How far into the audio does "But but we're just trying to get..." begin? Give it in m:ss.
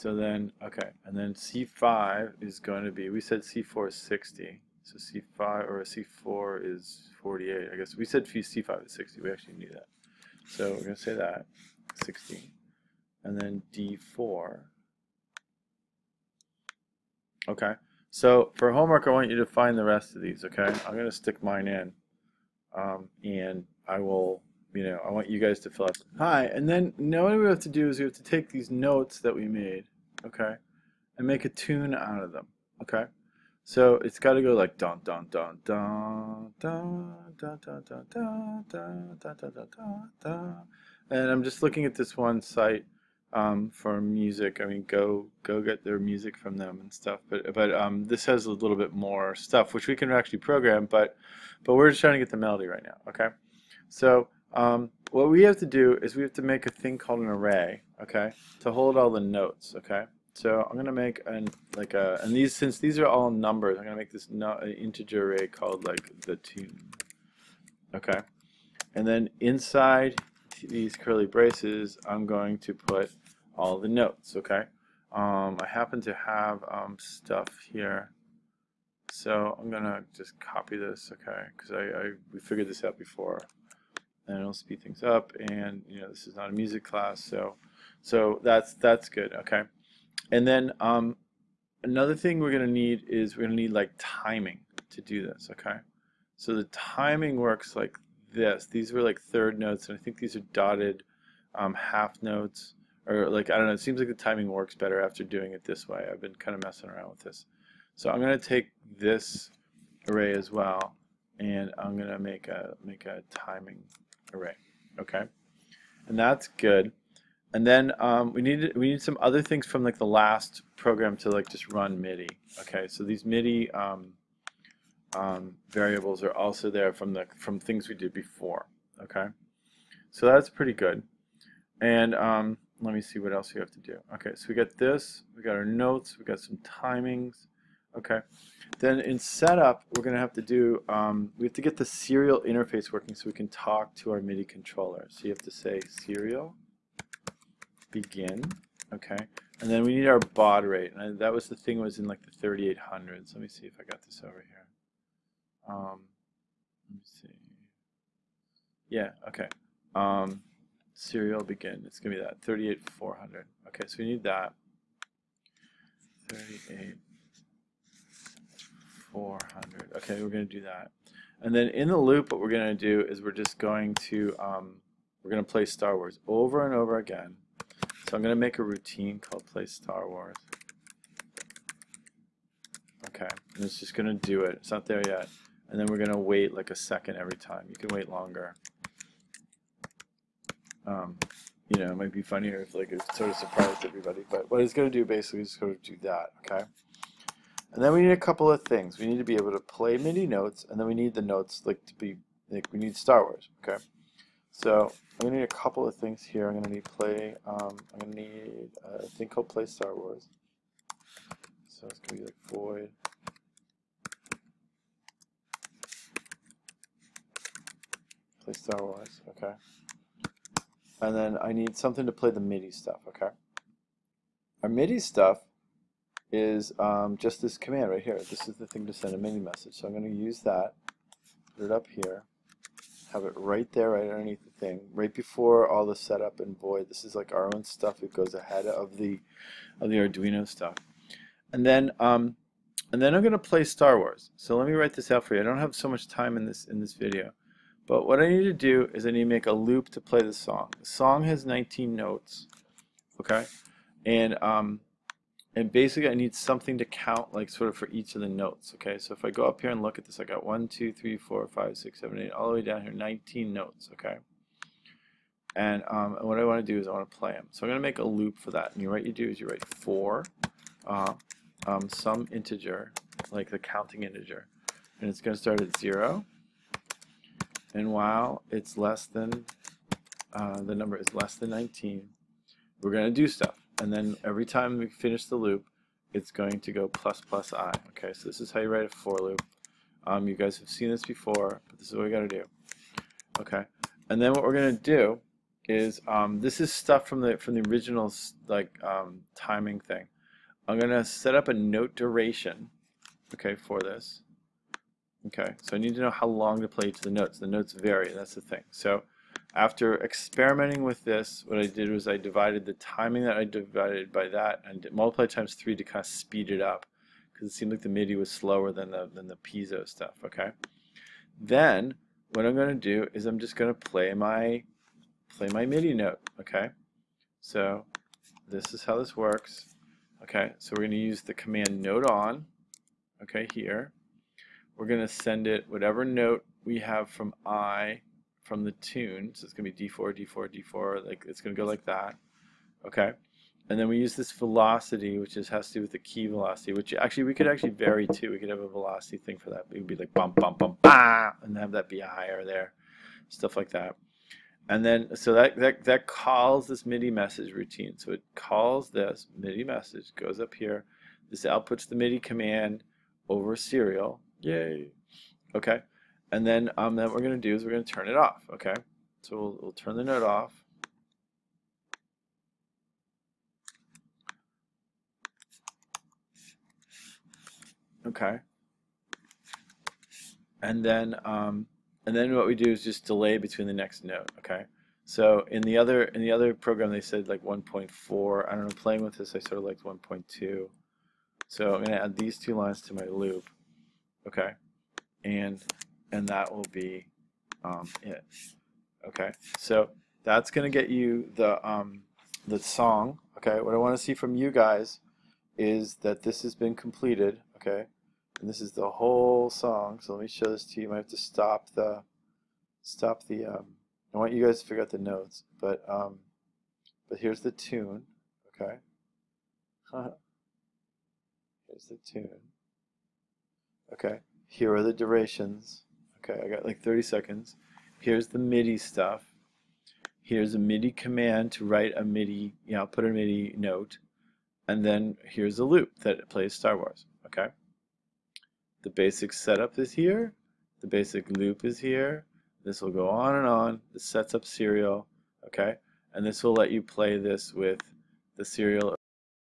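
0:50.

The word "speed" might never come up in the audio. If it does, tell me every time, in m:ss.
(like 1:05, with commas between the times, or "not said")
1:24, 5:16.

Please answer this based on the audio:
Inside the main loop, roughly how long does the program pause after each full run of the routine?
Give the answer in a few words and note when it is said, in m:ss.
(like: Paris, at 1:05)
a second, at 3:06.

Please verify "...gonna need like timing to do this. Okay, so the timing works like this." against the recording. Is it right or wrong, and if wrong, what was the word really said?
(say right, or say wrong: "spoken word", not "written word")
right.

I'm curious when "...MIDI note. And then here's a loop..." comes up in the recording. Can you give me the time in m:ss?
7:13.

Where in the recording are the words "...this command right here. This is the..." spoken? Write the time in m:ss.
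3:47.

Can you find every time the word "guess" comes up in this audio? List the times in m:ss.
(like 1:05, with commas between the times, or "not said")
0:07.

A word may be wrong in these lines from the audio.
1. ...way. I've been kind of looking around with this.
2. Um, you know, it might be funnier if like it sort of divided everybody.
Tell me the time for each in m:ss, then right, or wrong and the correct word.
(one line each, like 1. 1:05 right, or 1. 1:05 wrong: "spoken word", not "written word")
1. 1:45 wrong: "messing", not "looking"
2. 3:10 wrong: "surprised", not "divided".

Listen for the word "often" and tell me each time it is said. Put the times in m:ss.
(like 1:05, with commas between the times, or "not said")
not said.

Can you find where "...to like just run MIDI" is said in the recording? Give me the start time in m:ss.
2:01.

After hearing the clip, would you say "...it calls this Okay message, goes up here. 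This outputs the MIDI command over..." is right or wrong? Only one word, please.
wrong.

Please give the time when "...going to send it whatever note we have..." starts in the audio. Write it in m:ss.
5:34.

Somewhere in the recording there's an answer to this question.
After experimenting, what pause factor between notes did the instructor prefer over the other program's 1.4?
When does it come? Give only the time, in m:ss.
6:29.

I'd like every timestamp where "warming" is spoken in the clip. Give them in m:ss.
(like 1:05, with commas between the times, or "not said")
not said.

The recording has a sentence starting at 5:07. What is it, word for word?
The notes vary, that's the thing.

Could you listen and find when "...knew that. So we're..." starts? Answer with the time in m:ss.
0:09.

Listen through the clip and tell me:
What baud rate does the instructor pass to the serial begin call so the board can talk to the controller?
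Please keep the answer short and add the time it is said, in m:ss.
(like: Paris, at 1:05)
38400, at 2:42.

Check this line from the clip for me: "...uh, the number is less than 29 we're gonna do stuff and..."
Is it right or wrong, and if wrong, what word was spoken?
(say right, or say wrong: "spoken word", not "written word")
wrong: "19", not "29".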